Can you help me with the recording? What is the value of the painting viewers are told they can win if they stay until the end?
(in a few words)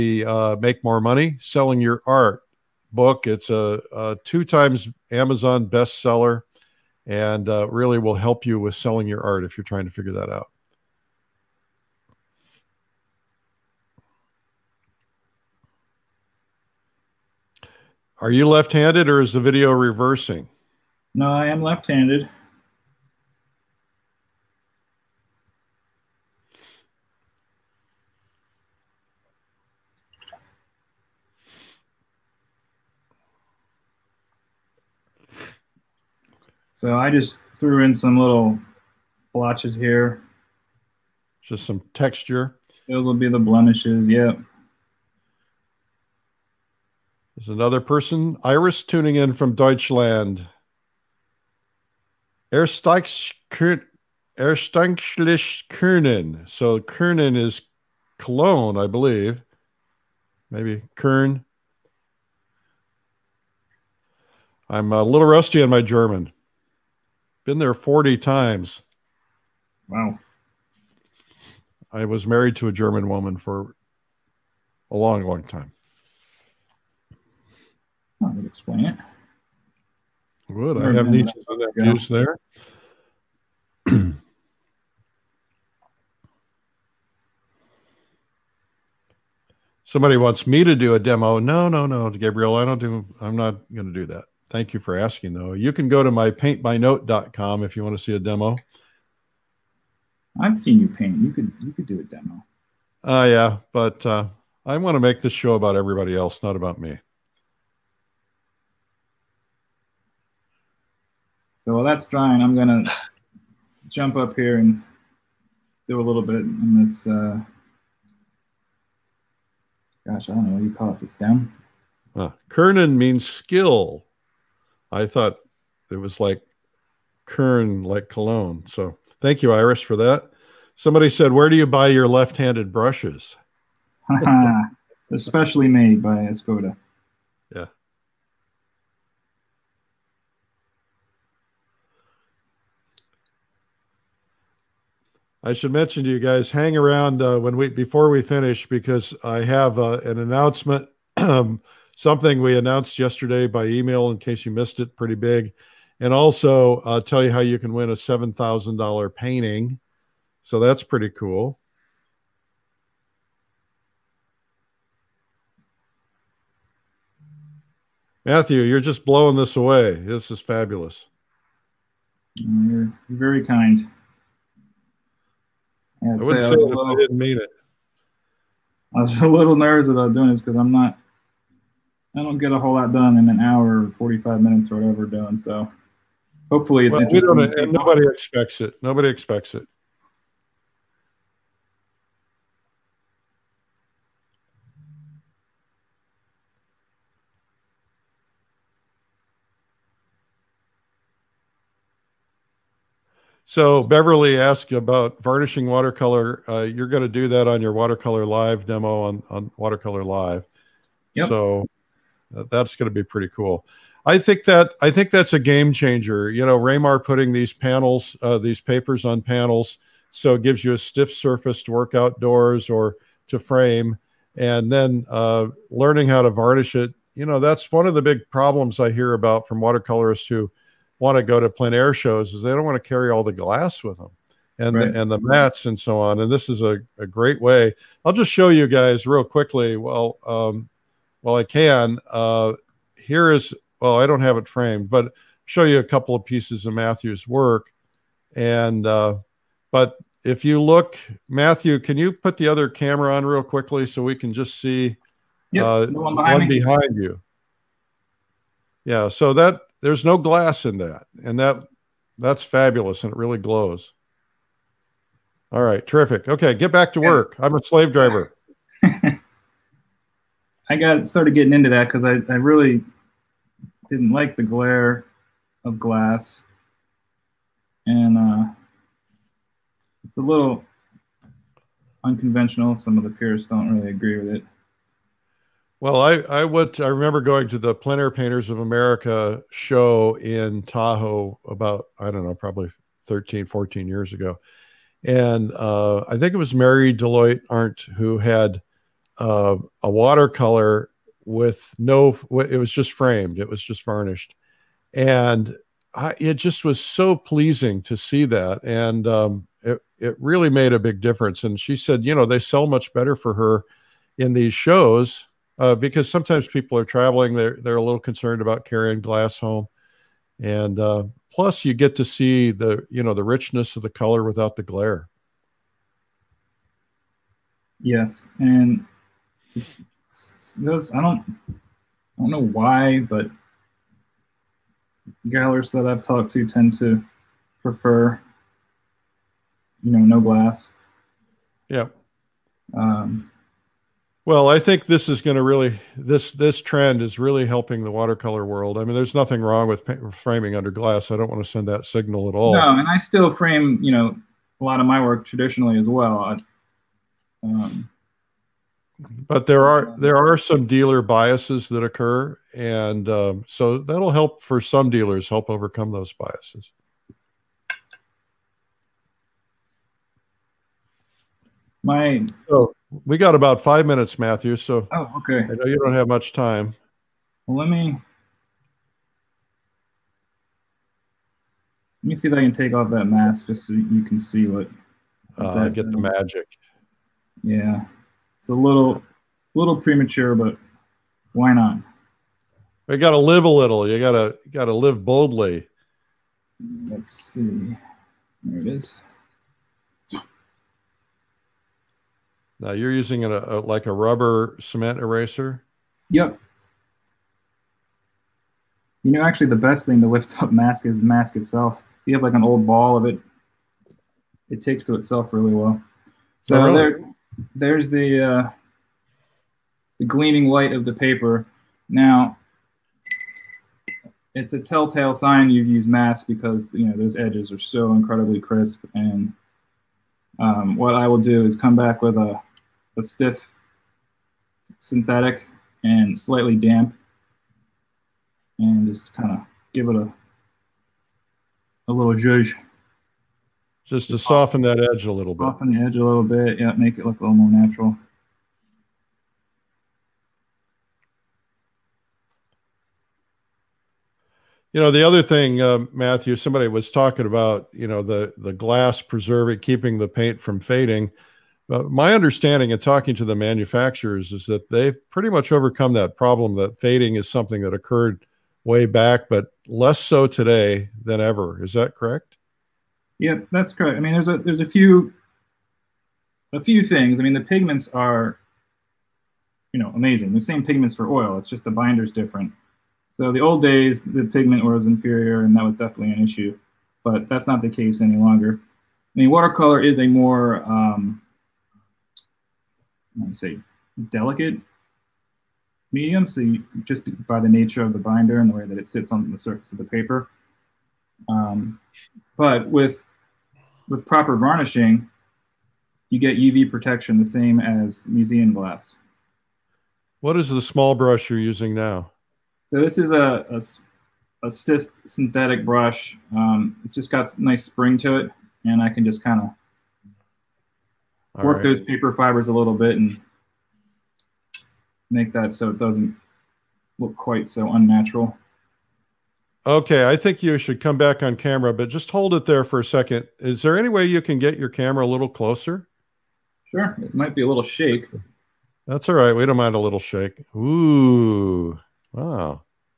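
$7,000.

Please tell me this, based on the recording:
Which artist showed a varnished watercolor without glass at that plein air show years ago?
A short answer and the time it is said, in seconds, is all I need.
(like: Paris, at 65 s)
Mary Deloyht-Arendt, at 296 s.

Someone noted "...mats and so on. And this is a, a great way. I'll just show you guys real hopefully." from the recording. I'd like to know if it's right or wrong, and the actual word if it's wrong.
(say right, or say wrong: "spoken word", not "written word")
wrong: "quickly", not "hopefully".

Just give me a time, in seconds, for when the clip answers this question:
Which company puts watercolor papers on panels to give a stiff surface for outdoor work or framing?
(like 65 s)
216 s.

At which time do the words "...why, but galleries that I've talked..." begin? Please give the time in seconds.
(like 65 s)
332 s.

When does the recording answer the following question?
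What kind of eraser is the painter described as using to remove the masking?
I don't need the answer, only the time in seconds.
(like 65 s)
403 s.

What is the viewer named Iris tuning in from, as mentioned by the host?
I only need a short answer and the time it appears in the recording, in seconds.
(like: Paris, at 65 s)
Deutschland, at 49 s.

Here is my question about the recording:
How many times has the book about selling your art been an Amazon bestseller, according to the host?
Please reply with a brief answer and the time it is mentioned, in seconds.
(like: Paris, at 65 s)
2, at 4 s.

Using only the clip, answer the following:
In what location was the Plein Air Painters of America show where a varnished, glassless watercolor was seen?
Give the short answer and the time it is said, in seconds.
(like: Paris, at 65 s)
Tahoe, at 290 s.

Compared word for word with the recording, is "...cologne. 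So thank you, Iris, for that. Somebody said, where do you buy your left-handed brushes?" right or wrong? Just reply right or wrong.
right.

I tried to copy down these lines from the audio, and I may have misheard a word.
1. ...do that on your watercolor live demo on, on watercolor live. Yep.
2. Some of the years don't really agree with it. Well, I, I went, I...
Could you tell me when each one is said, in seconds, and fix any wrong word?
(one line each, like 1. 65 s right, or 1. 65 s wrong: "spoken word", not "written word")
1. 207 s right
2. 282 s wrong: "peers", not "years".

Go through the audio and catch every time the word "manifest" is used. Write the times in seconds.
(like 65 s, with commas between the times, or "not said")
not said.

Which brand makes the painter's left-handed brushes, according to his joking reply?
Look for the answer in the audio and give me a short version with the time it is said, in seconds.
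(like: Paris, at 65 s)
Escoda, at 136 s.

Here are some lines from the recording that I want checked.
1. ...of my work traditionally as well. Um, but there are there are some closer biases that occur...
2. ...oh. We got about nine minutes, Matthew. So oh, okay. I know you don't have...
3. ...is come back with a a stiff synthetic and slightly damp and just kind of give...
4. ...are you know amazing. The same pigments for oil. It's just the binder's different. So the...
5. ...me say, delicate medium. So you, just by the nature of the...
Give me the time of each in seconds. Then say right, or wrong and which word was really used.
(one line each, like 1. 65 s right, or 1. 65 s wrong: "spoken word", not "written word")
1. 354 s wrong: "dealer", not "closer"
2. 372 s wrong: "five", not "nine"
3. 431 s right
4. 477 s right
5. 493 s right.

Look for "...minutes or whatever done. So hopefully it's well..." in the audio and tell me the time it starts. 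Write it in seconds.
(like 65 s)
184 s.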